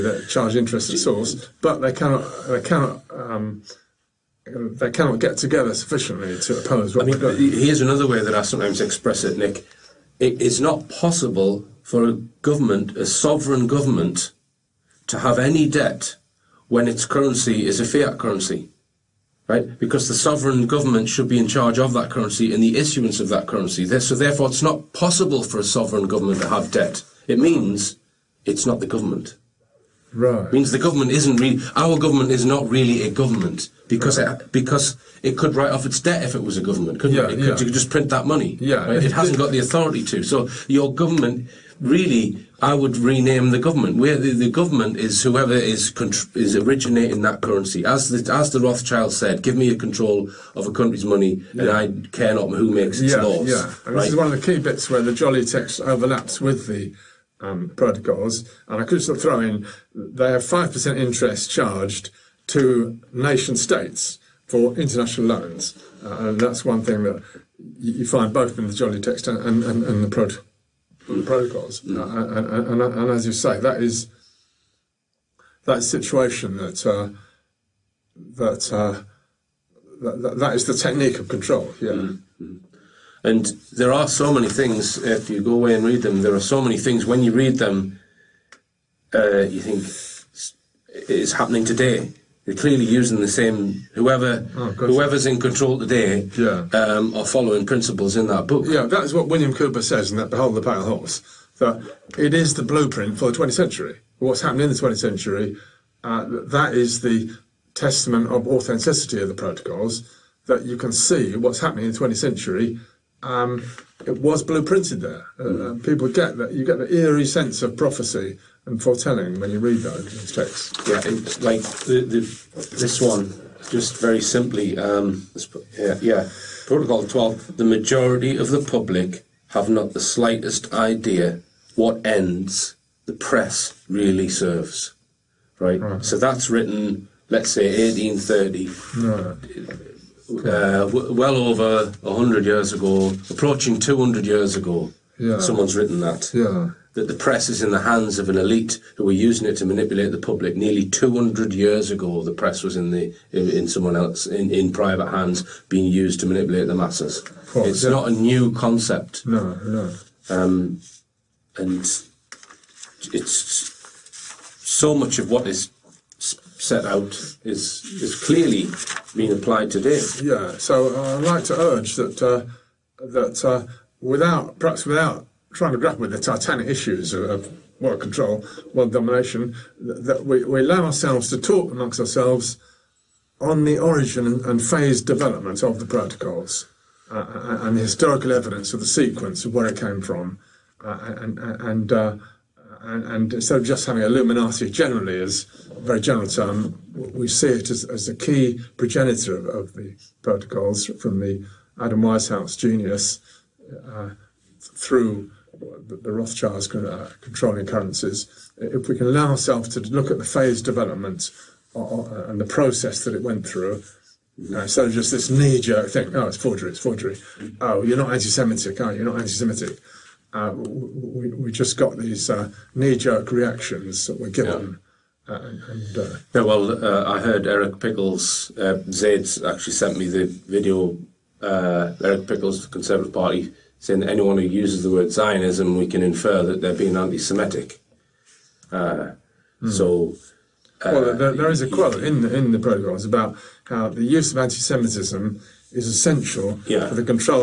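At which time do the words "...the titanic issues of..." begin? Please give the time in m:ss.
2:56.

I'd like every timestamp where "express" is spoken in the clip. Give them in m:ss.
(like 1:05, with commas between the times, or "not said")
0:08.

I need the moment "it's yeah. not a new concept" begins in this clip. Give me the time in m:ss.
2:37.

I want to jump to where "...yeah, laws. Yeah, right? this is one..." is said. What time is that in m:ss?
0:53.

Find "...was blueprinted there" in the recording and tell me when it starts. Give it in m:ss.
1:54.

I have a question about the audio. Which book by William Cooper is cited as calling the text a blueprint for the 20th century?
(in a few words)
Behold the Pale Horse.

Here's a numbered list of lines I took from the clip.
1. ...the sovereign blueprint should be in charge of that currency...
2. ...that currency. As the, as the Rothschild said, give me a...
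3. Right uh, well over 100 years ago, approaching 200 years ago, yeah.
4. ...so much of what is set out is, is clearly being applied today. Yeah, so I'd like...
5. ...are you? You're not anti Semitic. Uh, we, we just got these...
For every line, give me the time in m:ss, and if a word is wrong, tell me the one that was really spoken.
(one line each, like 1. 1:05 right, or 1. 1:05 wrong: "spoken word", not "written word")
1. 0:20 wrong: "government", not "blueprint"
2. 0:47 right
3. 2:19 right
4. 2:44 right
5. 3:38 right.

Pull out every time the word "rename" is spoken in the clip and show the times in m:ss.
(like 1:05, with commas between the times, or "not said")
0:42.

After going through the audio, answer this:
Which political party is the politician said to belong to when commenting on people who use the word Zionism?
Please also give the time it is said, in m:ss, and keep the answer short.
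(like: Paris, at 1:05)
Conservative Party, at 3:52.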